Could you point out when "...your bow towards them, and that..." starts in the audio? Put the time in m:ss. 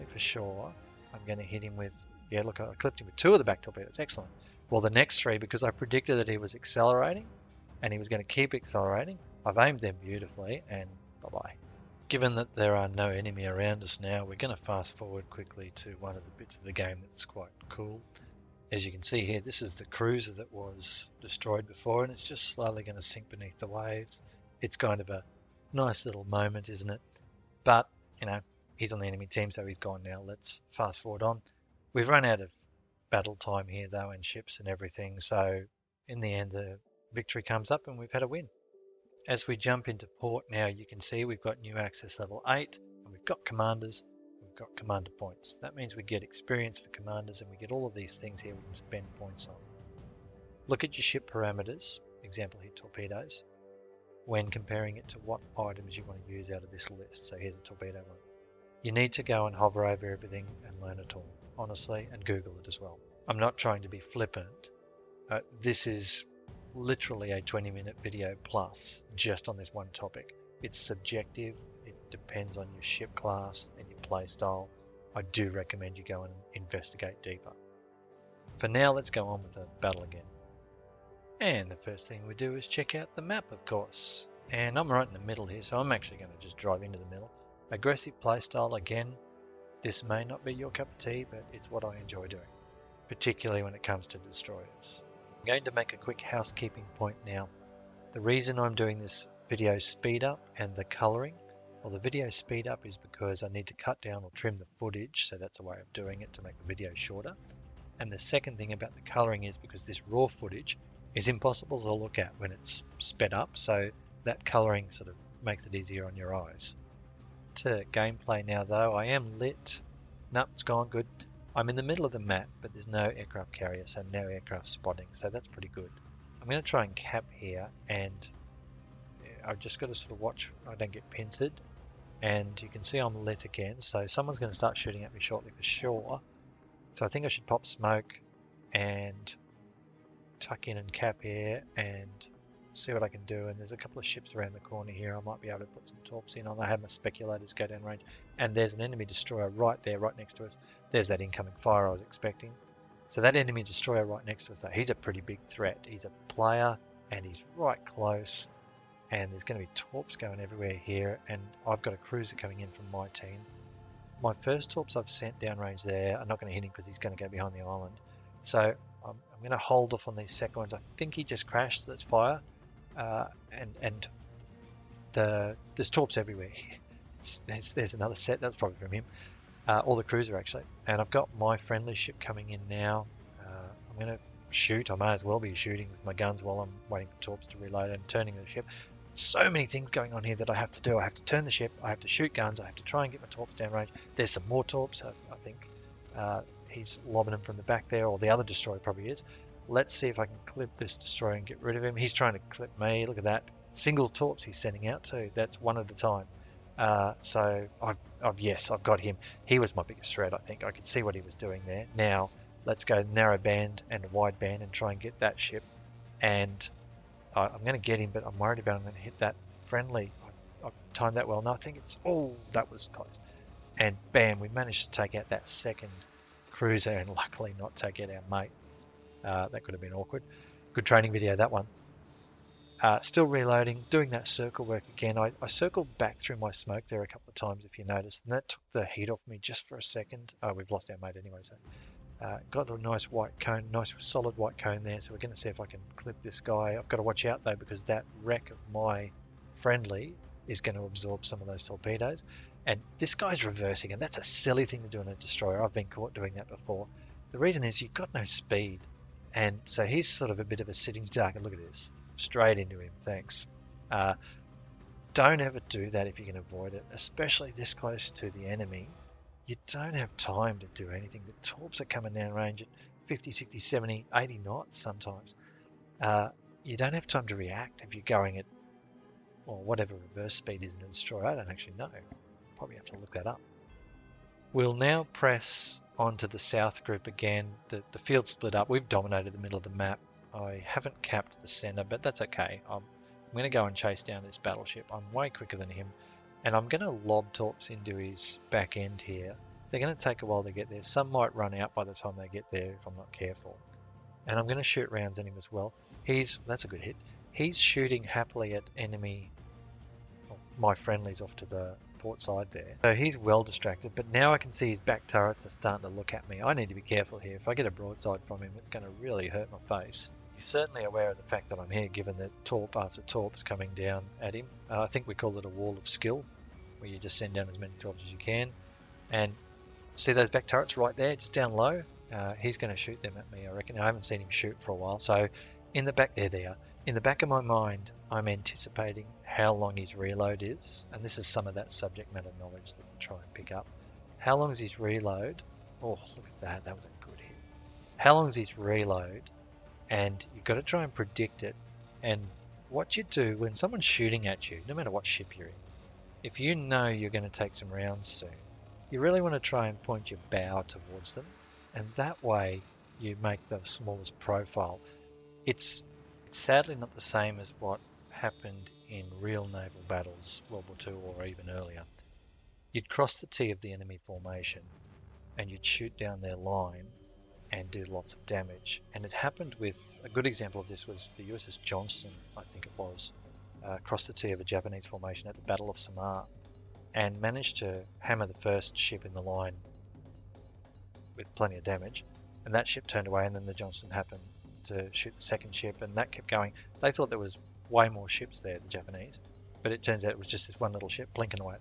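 6:00.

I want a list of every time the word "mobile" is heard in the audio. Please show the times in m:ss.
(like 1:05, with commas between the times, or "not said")
not said.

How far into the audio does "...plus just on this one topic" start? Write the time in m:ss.
1:08.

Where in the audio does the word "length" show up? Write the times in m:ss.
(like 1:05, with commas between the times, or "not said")
not said.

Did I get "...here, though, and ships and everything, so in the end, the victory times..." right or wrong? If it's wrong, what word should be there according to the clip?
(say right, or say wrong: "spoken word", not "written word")
wrong: "comes", not "times".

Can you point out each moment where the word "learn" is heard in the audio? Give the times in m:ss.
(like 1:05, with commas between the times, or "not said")
1:00.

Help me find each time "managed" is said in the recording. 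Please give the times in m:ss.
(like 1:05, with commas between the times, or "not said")
3:44, 6:27.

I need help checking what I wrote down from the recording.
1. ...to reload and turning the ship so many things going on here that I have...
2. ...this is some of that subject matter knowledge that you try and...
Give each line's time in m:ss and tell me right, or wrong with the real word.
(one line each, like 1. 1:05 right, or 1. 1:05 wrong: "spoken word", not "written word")
1. 3:07 right
2. 5:41 right.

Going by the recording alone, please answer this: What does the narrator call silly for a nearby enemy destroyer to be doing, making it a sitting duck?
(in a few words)
Reversing.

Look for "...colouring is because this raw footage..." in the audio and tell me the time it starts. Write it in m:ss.
1:49.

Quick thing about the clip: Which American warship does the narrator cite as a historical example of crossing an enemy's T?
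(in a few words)
USS Johnston.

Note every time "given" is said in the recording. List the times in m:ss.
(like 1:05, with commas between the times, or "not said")
0:12, 5:21.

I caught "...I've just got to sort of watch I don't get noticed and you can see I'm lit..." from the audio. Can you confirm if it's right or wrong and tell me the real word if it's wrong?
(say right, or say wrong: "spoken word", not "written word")
wrong: "pincered", not "noticed".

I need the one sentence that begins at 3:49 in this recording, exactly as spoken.
Uh, that could have been awkward.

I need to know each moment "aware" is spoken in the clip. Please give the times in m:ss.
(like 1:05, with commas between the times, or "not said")
5:20.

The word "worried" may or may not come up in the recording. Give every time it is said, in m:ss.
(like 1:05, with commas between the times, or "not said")
3:38.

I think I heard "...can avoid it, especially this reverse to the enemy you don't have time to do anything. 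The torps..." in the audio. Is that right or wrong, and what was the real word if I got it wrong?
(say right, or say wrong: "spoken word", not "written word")
wrong: "close", not "reverse".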